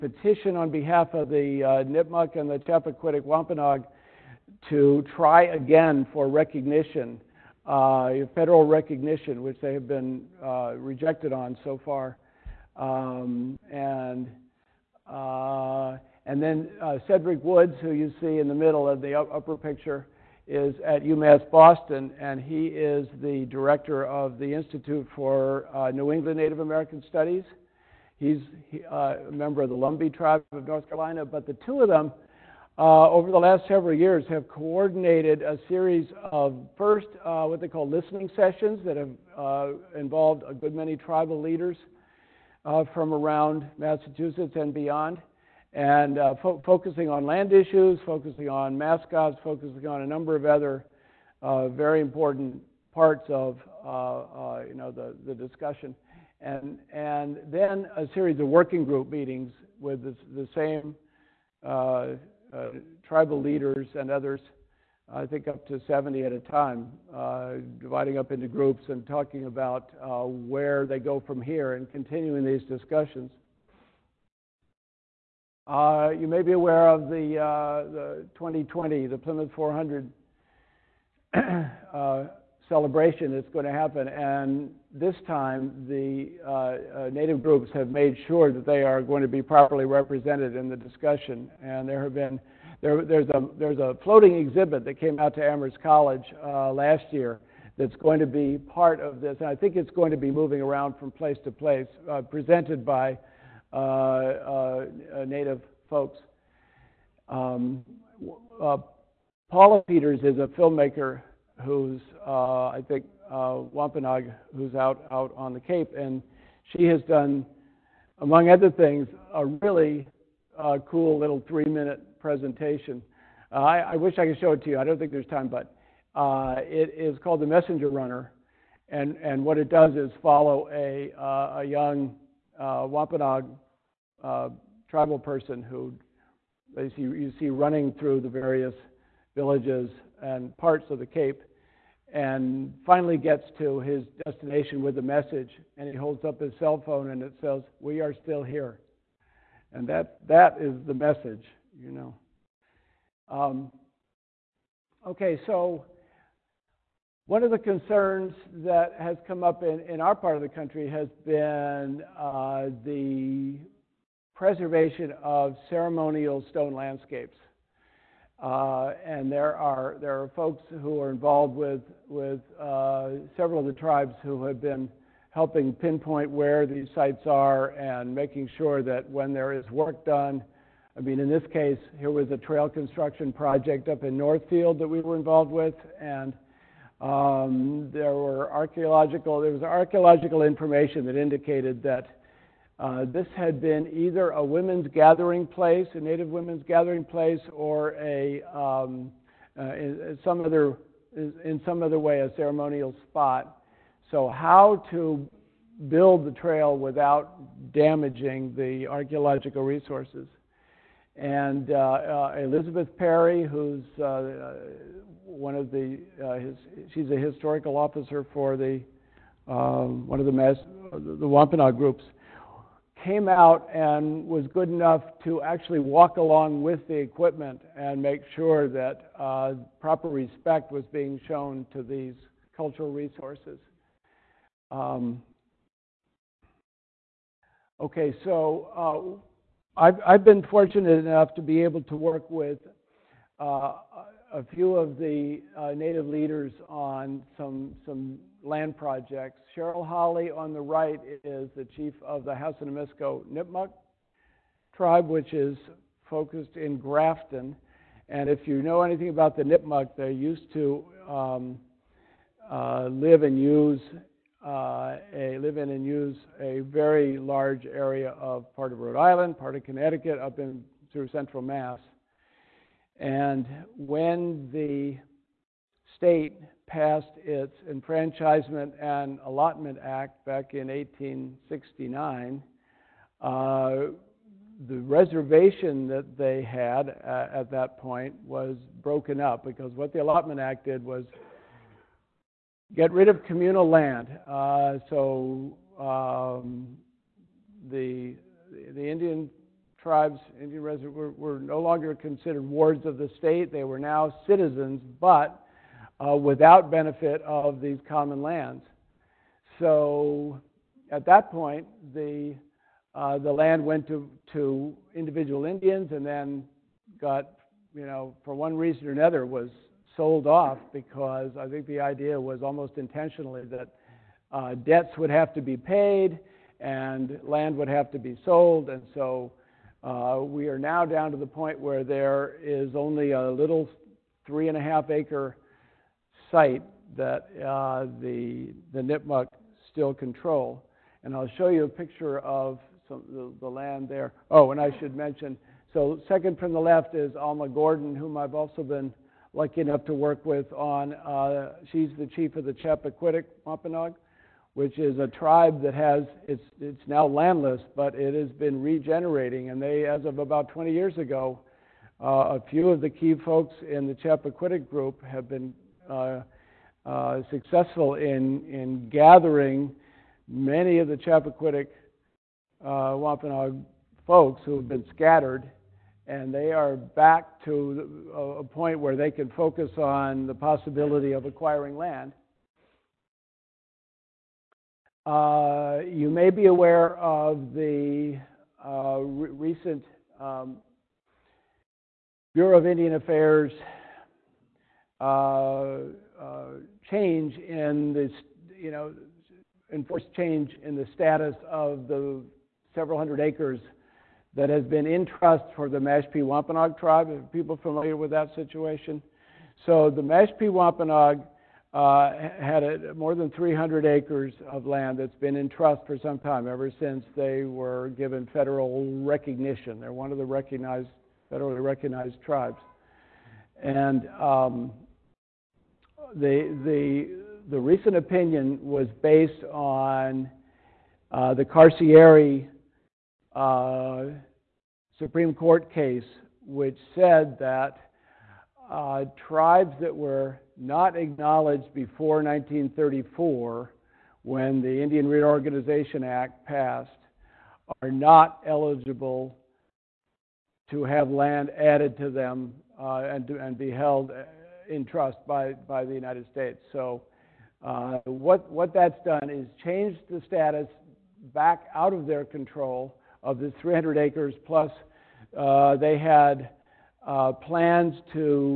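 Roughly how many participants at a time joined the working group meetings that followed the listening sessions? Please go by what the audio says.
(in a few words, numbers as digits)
70.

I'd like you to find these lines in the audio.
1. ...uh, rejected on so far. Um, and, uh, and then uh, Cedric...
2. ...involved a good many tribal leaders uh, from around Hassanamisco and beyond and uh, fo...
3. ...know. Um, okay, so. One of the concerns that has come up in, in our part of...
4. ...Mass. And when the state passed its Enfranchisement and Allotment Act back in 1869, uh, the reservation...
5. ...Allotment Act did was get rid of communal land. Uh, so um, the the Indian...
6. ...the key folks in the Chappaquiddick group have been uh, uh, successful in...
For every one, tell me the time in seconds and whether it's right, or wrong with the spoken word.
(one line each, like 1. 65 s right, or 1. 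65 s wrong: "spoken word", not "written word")
1. 10 s right
2. 39 s wrong: "Massachusetts", not "Hassanamisco"
3. 151 s right
4. 271 s right
5. 290 s right
6. 362 s right.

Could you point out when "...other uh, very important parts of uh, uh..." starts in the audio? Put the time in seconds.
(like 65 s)
50 s.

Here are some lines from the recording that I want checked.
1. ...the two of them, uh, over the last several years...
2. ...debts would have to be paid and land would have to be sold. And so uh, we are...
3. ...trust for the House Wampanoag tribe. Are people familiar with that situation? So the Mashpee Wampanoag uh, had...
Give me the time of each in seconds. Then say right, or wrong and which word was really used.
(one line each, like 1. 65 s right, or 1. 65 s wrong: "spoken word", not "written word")
1. 31 s right
2. 324 s right
3. 405 s wrong: "Mashpee", not "House".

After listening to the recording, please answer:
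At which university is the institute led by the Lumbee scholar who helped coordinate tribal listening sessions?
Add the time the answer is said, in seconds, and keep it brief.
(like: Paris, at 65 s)
UMass Boston, at 21 s.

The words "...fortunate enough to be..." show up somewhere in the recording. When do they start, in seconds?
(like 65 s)
240 s.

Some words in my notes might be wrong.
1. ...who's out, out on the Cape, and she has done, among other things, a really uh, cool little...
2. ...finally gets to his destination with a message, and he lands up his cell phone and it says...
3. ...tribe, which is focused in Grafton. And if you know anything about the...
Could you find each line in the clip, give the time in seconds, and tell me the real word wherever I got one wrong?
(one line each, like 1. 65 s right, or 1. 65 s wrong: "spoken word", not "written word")
1. 114 s right
2. 142 s wrong: "holds", not "lands"
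3. 254 s right.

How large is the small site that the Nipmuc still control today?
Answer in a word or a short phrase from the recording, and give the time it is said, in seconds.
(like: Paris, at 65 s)
3.5 acres, at 334 s.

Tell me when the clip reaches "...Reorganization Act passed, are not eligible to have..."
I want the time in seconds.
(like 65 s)
445 s.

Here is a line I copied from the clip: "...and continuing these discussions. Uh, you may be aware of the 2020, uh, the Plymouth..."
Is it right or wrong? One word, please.
right.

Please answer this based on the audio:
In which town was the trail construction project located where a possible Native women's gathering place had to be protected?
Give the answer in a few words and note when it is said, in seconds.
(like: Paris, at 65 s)
Northfield, at 184 s.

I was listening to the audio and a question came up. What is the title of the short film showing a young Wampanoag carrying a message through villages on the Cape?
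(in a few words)
The Messenger Runner.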